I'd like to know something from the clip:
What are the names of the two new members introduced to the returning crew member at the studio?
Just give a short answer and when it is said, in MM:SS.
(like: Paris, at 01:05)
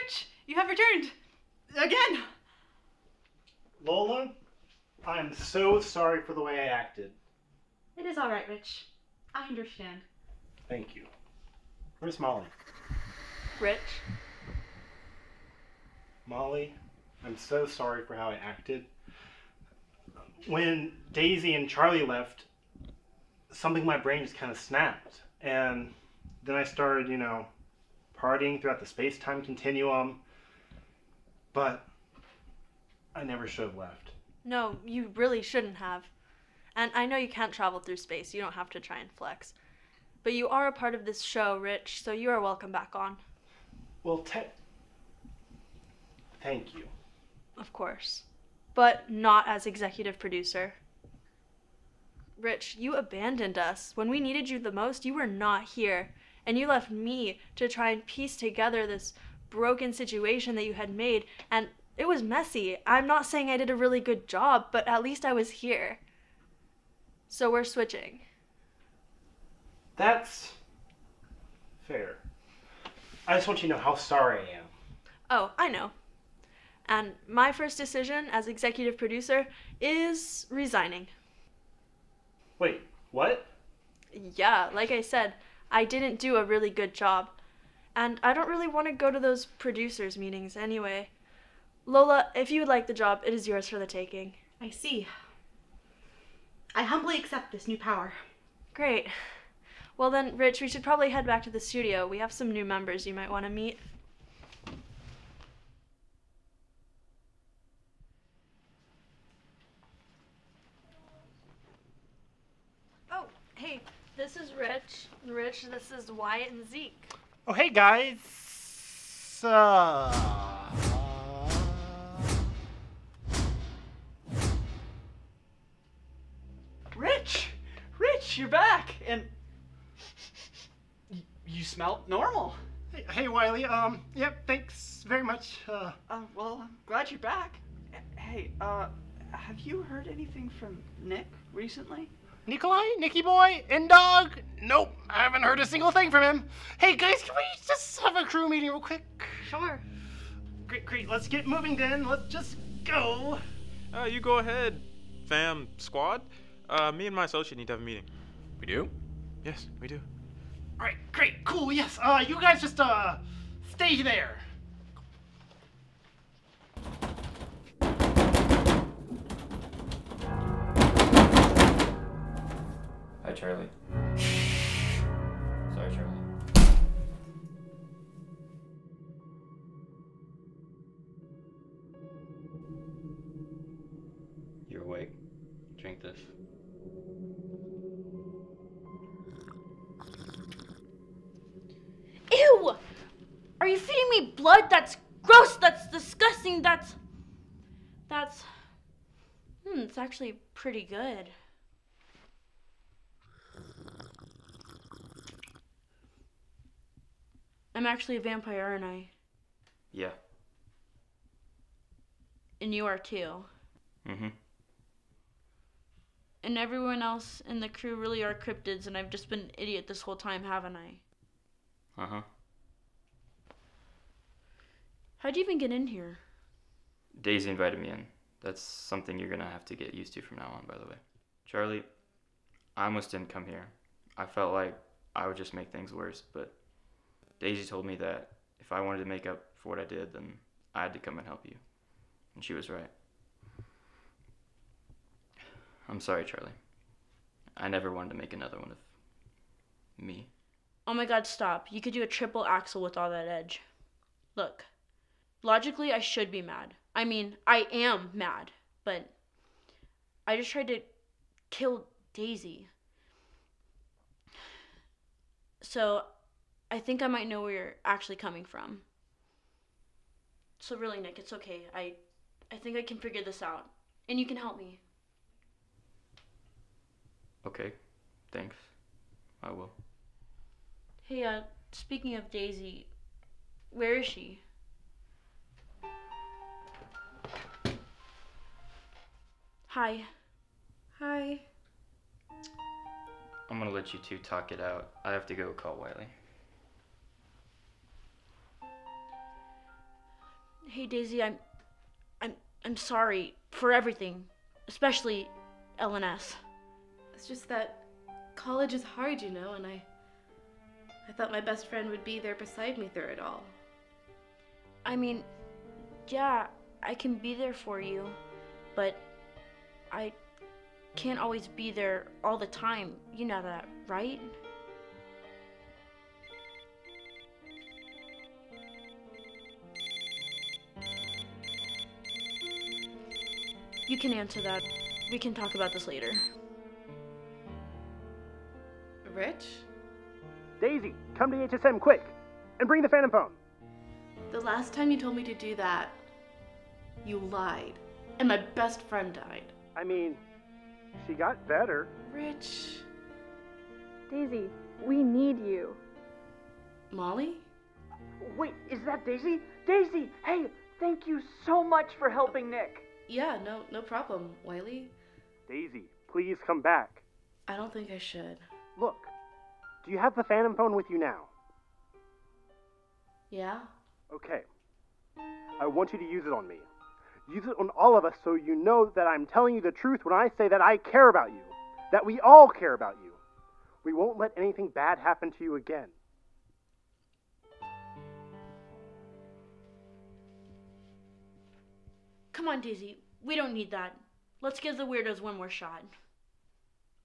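Wyatt and Zeke, at 01:56.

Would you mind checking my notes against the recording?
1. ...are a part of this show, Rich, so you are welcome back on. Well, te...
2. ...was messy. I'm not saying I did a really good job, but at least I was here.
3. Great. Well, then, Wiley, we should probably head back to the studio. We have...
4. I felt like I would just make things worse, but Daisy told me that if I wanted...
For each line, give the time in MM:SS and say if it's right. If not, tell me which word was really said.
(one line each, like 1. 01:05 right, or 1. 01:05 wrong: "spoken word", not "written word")
1. 00:40 right
2. 01:02 right
3. 01:38 wrong: "Rich", not "Wiley"
4. 03:54 right.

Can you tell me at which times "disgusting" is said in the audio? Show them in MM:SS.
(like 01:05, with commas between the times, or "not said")
03:15.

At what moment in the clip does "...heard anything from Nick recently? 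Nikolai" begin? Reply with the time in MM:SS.
02:19.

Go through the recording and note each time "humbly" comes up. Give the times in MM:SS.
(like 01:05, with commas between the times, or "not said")
01:36.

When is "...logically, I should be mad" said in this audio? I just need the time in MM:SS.
04:15.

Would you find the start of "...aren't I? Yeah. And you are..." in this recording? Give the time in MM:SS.
03:28.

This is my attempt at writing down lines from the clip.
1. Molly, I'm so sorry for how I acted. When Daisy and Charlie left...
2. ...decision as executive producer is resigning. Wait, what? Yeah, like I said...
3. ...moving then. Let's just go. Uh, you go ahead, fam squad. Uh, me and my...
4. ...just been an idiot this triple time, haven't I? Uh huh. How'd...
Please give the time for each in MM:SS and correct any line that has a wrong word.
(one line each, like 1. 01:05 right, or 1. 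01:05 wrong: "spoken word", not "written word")
1. 00:16 right
2. 01:17 right
3. 02:31 right
4. 03:39 wrong: "whole", not "triple".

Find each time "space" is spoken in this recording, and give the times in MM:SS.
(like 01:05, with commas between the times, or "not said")
00:28, 00:37.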